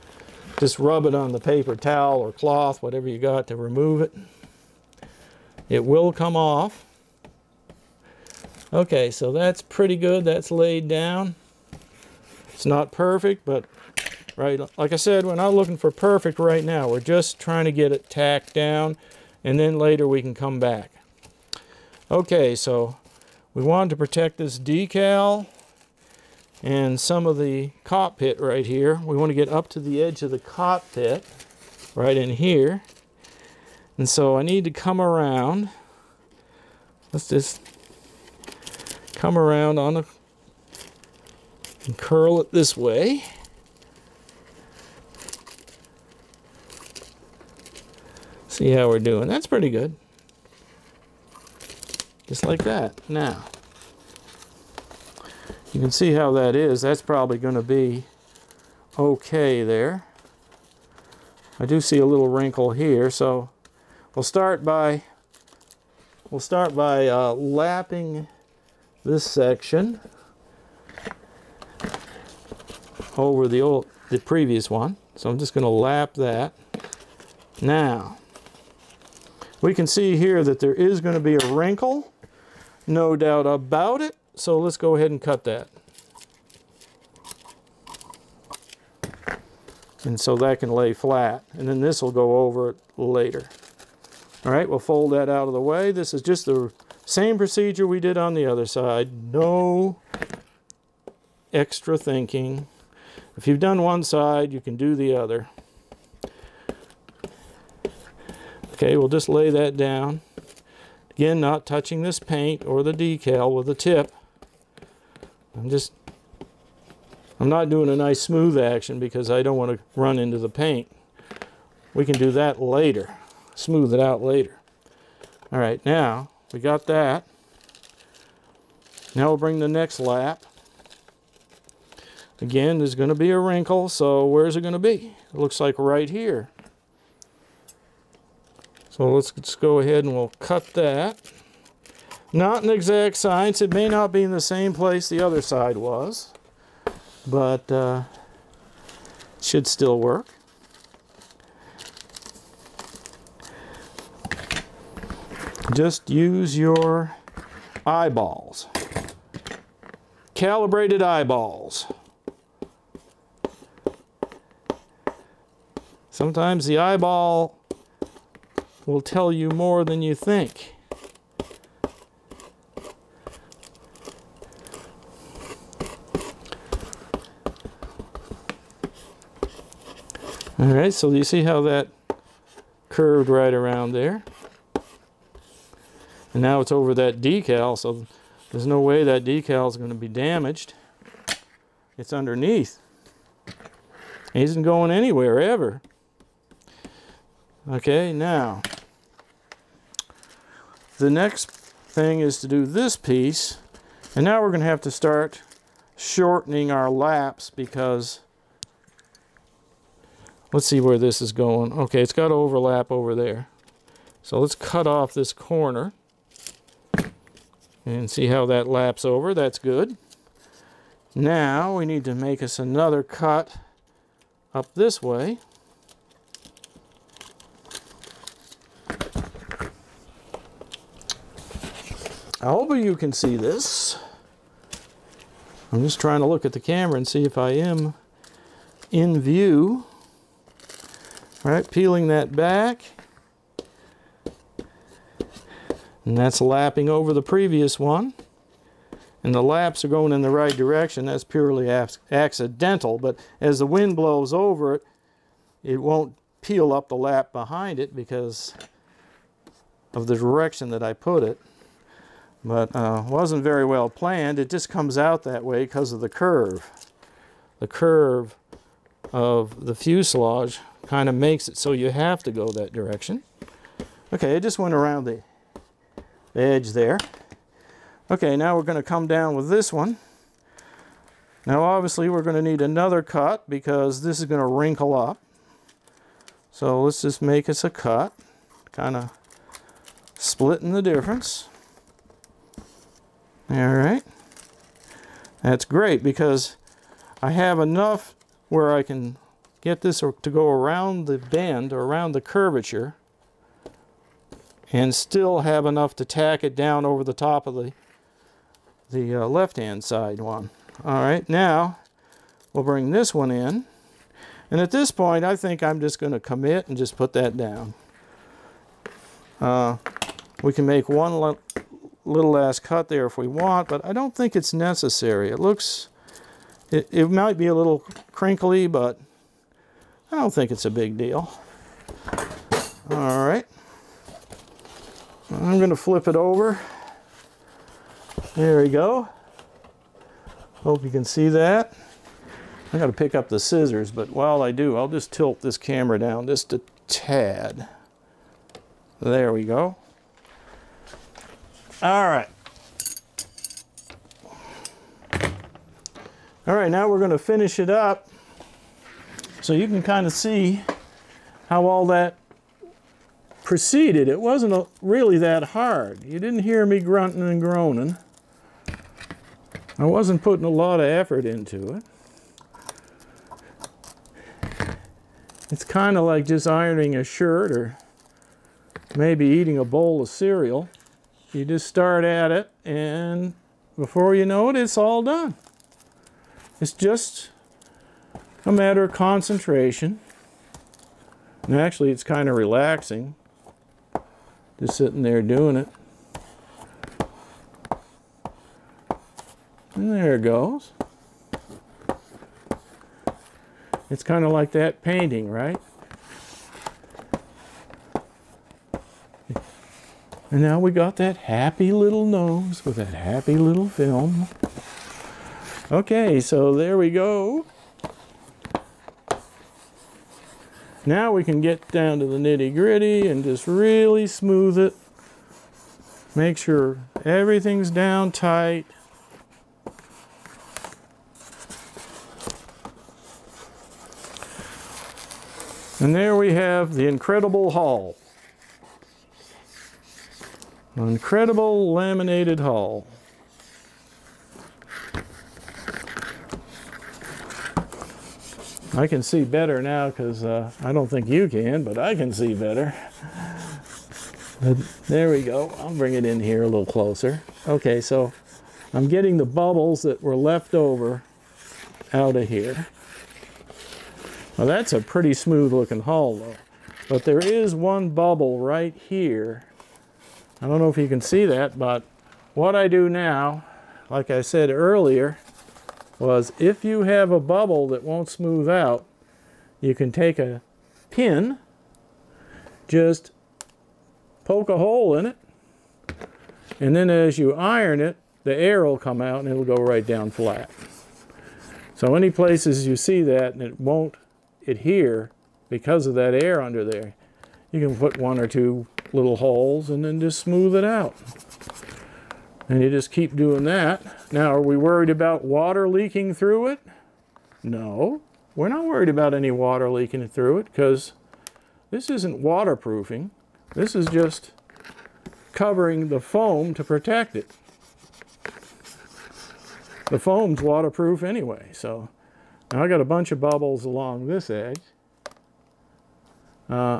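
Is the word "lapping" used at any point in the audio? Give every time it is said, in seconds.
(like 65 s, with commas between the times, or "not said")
67 s, 246 s.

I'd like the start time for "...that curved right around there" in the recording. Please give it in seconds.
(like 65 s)
181 s.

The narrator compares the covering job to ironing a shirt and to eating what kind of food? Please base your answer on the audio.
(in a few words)
bowl of cereal.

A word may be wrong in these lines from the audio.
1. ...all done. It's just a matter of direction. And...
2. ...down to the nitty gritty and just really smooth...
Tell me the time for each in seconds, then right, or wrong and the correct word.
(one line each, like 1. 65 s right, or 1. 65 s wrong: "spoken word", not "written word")
1. 384 s wrong: "concentration", not "direction"
2. 421 s right.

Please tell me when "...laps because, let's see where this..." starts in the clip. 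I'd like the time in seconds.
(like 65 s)
206 s.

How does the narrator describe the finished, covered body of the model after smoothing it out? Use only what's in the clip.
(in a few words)
incredible laminated hull.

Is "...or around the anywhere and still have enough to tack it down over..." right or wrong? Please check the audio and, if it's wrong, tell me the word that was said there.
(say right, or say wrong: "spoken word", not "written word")
wrong: "curvature", not "anywhere".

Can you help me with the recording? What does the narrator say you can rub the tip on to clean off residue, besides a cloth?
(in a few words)
paper towel.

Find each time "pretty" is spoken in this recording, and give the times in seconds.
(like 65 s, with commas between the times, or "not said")
9 s, 49 s, 464 s.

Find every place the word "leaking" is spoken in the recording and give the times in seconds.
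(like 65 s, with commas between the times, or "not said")
505 s, 509 s.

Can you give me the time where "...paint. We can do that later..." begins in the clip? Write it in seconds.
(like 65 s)
120 s.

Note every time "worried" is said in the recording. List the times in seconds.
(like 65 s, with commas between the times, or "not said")
504 s, 508 s.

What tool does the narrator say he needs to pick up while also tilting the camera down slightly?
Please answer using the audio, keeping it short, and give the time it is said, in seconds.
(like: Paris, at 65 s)
scissors, at 343 s.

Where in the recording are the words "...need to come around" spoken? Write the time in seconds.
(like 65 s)
34 s.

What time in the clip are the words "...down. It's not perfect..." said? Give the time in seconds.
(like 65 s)
10 s.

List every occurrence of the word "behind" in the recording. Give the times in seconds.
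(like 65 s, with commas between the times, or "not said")
257 s.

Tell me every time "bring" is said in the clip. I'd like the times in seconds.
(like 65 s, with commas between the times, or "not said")
129 s, 312 s, 455 s.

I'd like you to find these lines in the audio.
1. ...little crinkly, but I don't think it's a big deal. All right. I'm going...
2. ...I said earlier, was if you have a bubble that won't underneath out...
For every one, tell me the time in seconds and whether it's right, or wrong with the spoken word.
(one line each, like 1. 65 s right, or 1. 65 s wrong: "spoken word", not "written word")
1. 327 s right
2. 474 s wrong: "smooth", not "underneath".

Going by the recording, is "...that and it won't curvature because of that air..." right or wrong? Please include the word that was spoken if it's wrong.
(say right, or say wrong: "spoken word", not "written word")
wrong: "adhere", not "curvature".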